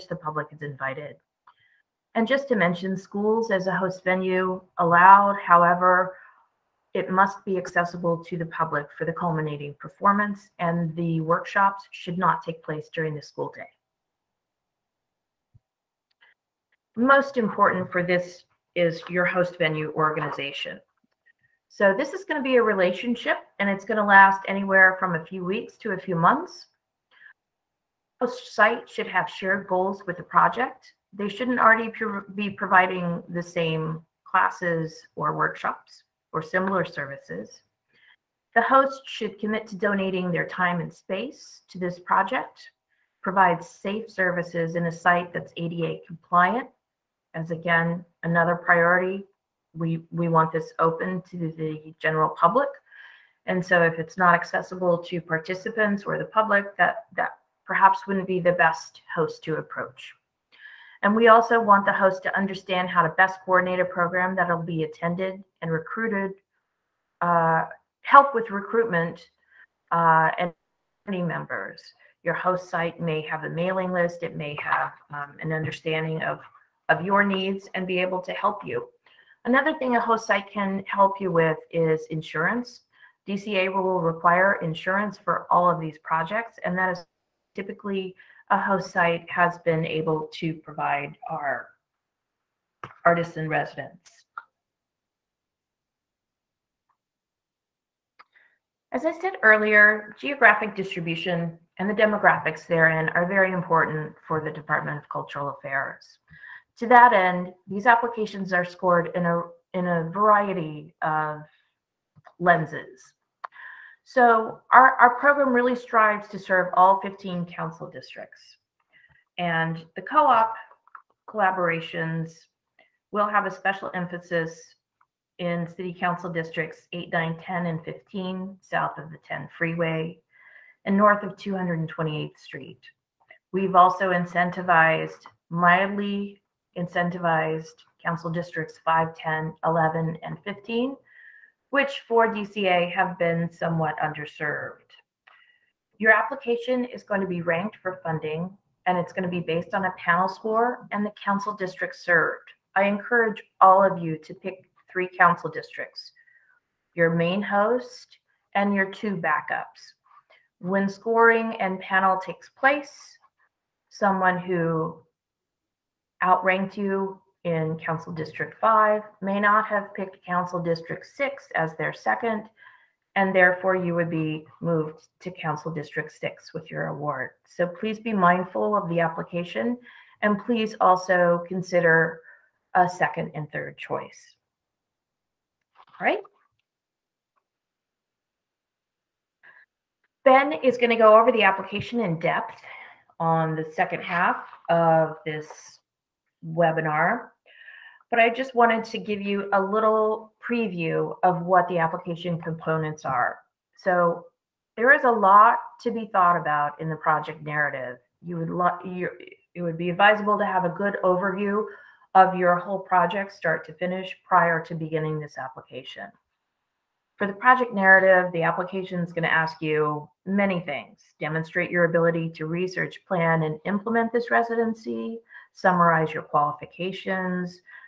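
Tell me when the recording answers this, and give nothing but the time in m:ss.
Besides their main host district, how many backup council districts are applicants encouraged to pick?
2:38.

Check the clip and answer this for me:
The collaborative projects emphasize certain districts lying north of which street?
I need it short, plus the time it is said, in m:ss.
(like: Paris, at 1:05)
228th Street, at 2:11.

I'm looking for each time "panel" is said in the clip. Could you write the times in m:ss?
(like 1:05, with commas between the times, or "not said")
2:29, 2:41.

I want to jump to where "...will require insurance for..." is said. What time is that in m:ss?
1:23.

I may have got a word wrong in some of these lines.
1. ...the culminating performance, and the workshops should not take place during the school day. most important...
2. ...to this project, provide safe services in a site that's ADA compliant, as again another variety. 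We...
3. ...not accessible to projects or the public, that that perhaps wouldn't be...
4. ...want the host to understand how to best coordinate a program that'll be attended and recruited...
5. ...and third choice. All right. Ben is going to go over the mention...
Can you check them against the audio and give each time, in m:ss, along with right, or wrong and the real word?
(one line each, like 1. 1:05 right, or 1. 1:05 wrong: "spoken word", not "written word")
1. 0:09 right
2. 0:41 wrong: "priority", not "variety"
3. 0:54 wrong: "participants", not "projects"
4. 1:01 right
5. 3:03 wrong: "application", not "mention".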